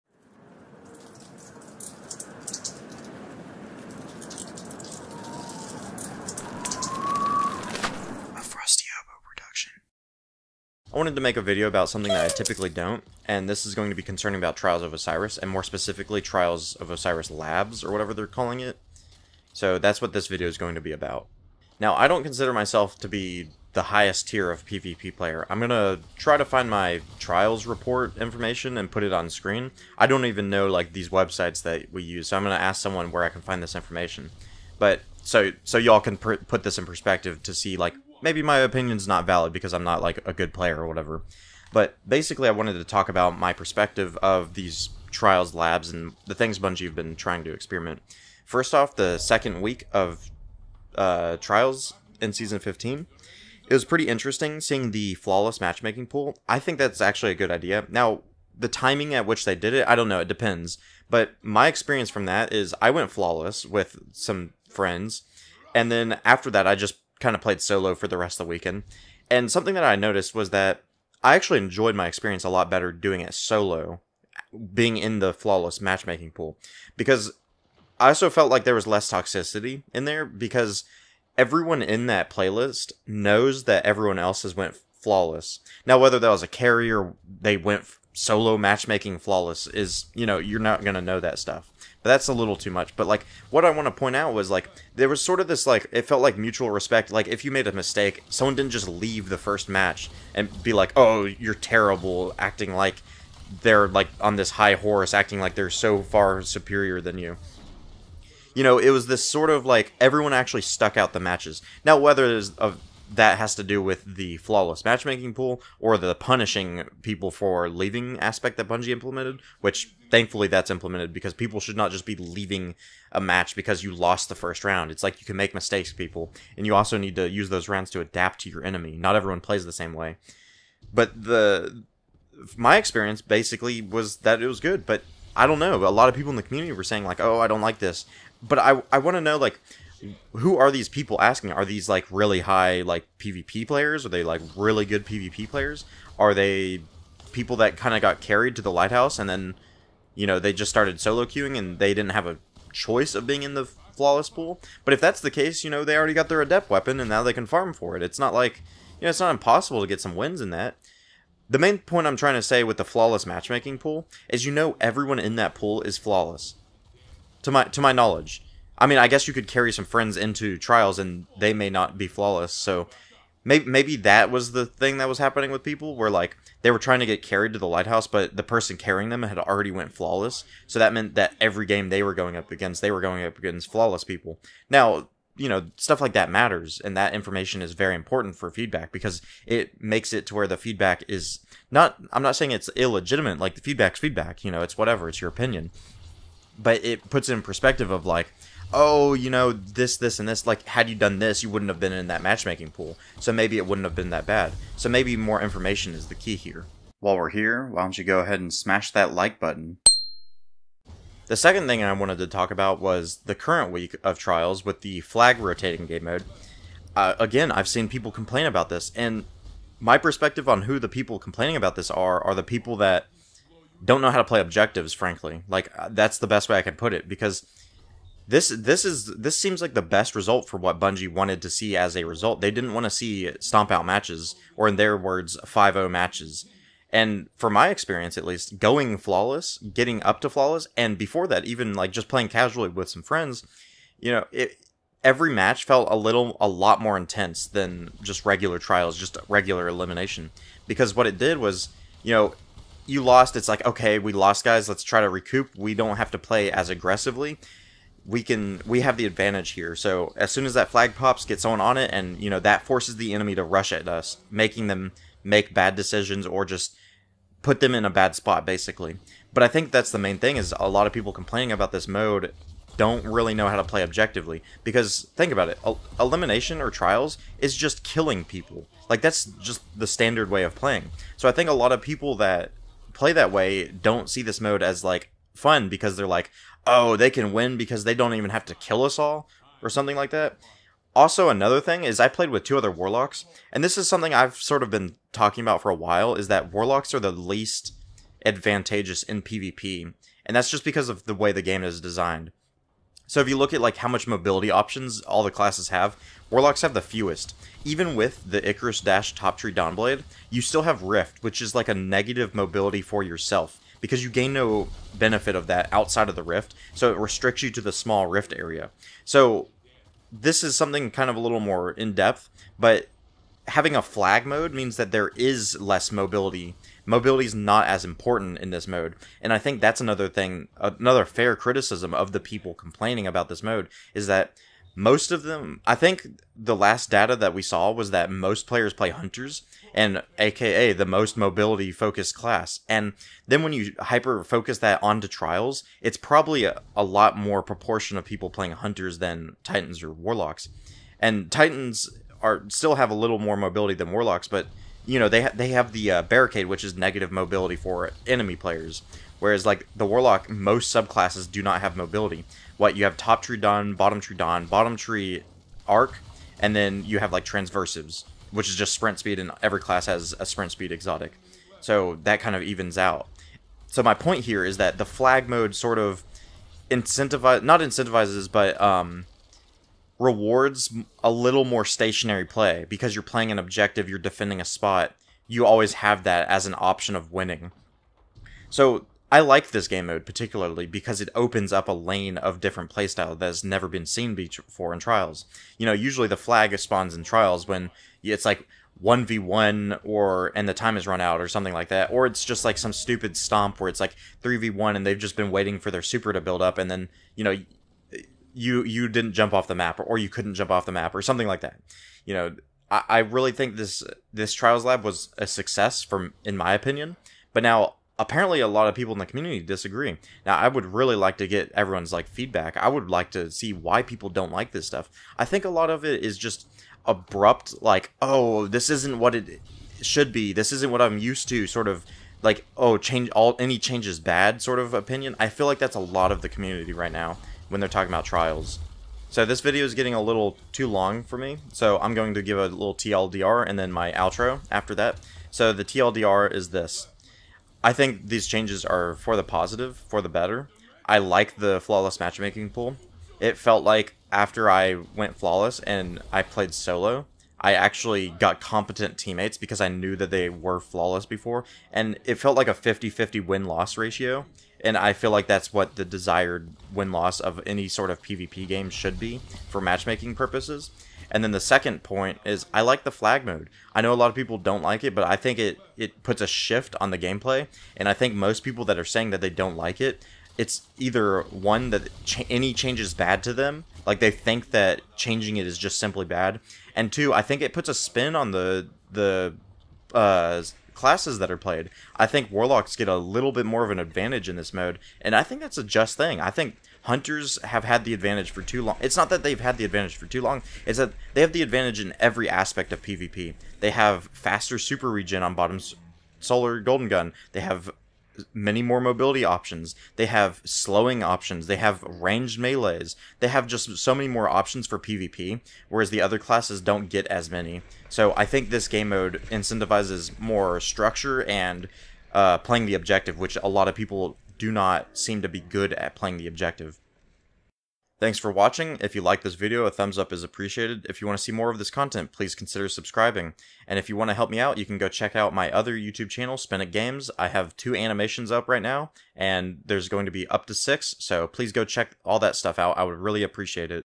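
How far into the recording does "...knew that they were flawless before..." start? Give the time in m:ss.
7:39.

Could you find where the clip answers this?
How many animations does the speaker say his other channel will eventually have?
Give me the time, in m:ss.
9:00.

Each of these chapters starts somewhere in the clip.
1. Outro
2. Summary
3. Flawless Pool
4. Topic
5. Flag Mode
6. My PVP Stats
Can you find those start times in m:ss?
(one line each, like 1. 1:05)
1. 8:43
2. 7:14
3. 0:48
4. 0:10
5. 3:26
6. 0:21.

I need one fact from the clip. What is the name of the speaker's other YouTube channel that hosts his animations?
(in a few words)
Spenik Games.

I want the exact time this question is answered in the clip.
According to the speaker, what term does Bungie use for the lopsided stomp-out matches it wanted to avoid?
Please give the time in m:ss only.
3:55.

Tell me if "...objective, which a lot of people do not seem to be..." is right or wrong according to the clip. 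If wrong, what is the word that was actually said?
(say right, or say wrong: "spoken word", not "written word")
right.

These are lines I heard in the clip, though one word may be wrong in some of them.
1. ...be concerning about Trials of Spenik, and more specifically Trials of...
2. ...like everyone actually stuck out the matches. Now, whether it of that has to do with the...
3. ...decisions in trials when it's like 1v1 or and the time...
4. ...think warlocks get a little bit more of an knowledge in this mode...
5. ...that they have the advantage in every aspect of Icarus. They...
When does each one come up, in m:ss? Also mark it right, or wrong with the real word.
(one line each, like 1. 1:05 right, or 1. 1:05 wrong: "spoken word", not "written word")
1. 0:13 wrong: "Osiris", not "Spenik"
2. 1:49 right
3. 6:36 wrong: "spawns", not "decisions"
4. 8:12 wrong: "advantage", not "knowledge"
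5. 8:20 wrong: "PvP", not "Icarus".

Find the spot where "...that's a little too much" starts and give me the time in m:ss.
1:32.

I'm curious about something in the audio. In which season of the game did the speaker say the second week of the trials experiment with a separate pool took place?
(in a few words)
Season 15.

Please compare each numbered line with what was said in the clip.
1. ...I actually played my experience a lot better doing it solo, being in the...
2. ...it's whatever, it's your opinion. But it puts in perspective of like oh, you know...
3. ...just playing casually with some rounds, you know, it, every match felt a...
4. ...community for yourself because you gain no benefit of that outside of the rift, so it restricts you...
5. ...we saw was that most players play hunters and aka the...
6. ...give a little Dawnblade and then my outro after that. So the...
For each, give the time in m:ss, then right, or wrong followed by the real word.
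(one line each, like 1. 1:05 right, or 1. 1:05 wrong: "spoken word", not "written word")
1. 1:11 wrong: "enjoyed", not "played"
2. 3:14 right
3. 4:01 wrong: "friends", not "rounds"
4. 5:12 wrong: "mobility", not "community"
5. 5:37 right
6. 7:22 wrong: "TLDR", not "Dawnblade".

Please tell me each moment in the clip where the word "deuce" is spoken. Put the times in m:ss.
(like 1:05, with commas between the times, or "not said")
not said.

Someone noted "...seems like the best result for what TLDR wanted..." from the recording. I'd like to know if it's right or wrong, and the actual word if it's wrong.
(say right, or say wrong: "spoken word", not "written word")
wrong: "Bungie", not "TLDR".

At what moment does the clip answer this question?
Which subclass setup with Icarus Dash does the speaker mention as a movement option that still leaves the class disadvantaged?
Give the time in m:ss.
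5:09.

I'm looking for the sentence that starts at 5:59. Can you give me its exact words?
Whereas like the warlock, most subclasses do not have mobility.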